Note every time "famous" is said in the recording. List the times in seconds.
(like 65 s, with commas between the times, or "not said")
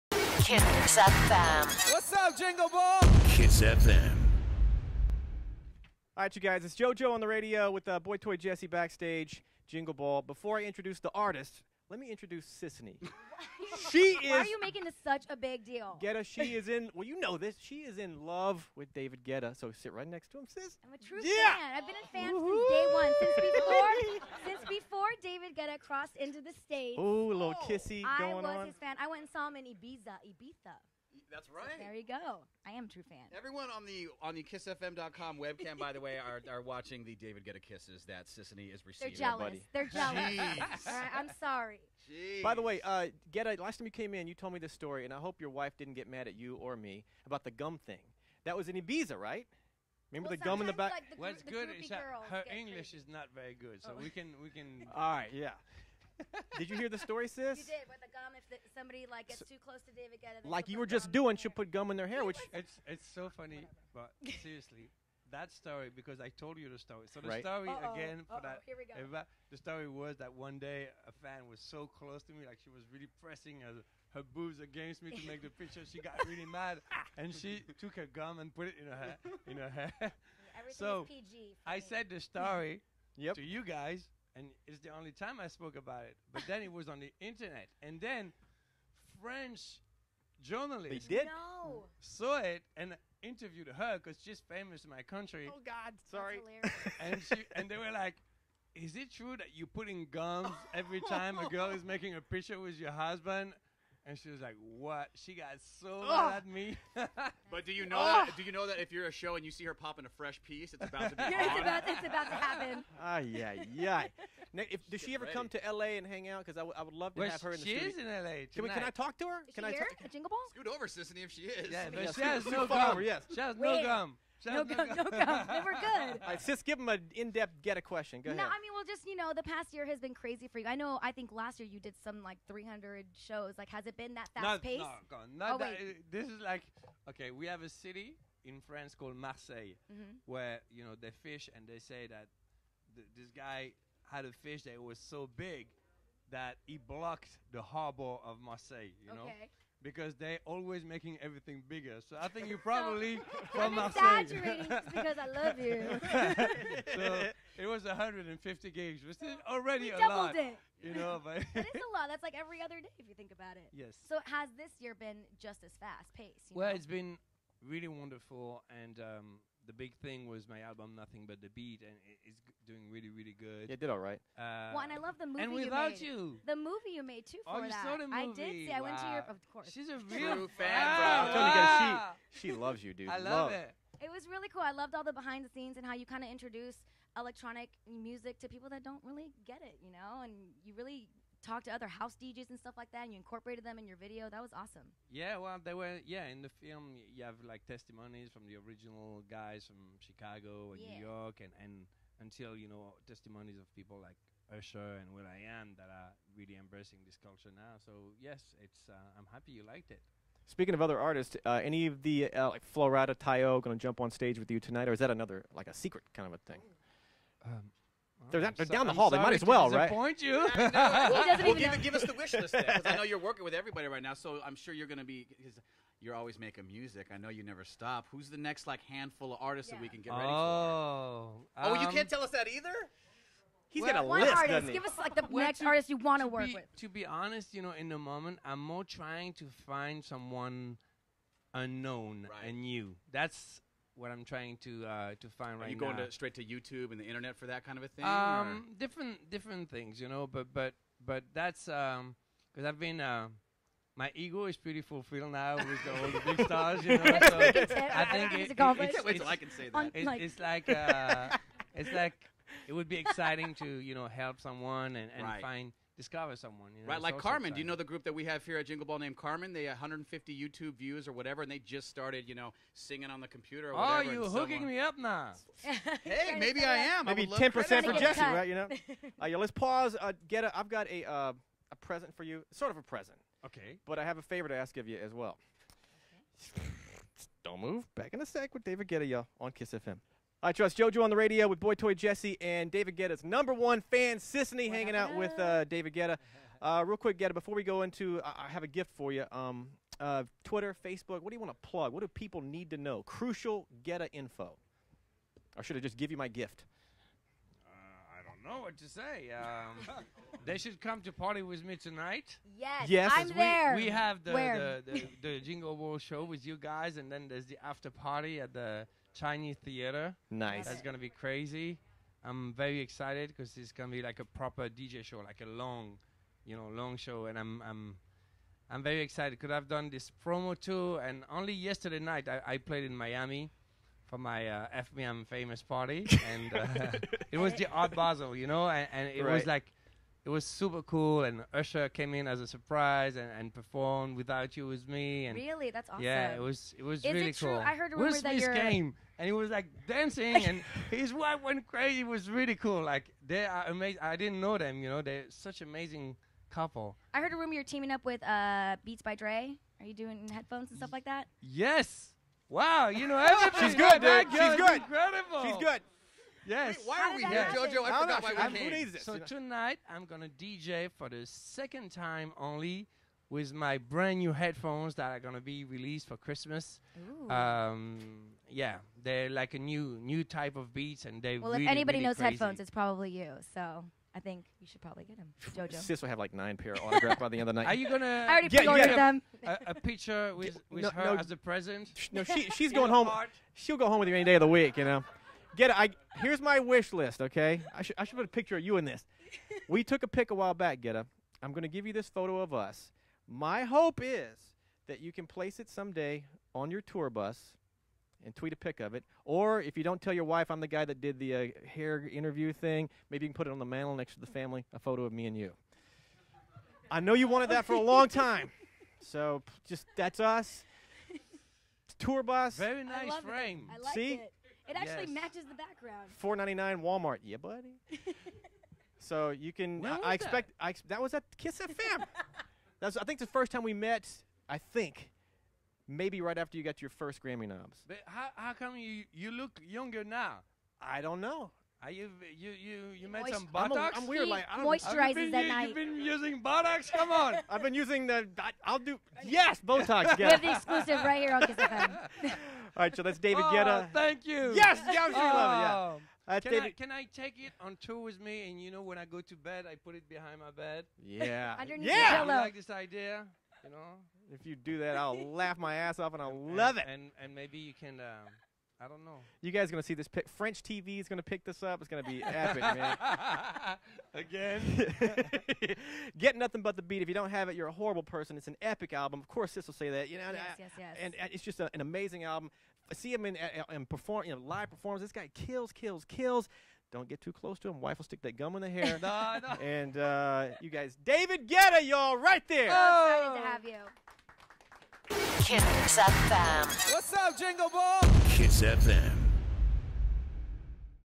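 94 s, 335 s.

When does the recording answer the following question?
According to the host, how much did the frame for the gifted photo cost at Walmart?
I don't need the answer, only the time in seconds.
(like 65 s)
426 s.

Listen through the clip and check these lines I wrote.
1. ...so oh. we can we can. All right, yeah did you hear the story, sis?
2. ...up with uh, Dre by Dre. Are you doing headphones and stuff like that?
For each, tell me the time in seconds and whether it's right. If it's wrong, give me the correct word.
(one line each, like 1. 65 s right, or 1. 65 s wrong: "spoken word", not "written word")
1. 53 s right
2. 357 s wrong: "Beats", not "Dre".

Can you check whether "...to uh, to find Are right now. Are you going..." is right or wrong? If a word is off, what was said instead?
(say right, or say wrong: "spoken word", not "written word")
right.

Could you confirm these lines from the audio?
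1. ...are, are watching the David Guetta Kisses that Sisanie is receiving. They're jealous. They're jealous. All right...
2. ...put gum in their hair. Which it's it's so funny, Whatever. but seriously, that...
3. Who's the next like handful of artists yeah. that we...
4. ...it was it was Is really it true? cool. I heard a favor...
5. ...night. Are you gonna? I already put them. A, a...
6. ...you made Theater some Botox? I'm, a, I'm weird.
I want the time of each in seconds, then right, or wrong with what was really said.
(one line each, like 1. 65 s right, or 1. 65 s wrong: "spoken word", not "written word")
1. 36 s right
2. 61 s right
3. 228 s right
4. 346 s wrong: "rumor", not "favor"
5. 387 s right
6. 443 s wrong: "Moist", not "Theater".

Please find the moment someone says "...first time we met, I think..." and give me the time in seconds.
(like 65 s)
433 s.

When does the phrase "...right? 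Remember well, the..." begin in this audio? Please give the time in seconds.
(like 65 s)
49 s.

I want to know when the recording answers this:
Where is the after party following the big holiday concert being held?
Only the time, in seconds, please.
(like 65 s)
319 s.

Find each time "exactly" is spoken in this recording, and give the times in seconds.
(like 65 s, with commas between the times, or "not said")
not said.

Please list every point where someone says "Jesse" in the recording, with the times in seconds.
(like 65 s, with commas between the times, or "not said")
8 s, 277 s, 291 s.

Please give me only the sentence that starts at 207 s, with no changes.
So yes, it's uh, I'm happy you liked it.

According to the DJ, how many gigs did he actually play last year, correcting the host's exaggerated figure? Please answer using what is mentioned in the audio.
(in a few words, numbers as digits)
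150.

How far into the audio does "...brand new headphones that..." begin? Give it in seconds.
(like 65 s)
373 s.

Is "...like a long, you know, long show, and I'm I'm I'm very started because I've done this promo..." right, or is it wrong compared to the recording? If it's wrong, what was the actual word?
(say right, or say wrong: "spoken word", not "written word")
wrong: "excited", not "started".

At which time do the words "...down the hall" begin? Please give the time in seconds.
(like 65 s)
218 s.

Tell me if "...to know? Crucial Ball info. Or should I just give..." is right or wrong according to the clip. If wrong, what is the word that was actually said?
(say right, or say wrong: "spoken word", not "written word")
wrong: "Guetta", not "Ball".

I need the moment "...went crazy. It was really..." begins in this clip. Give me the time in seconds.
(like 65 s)
351 s.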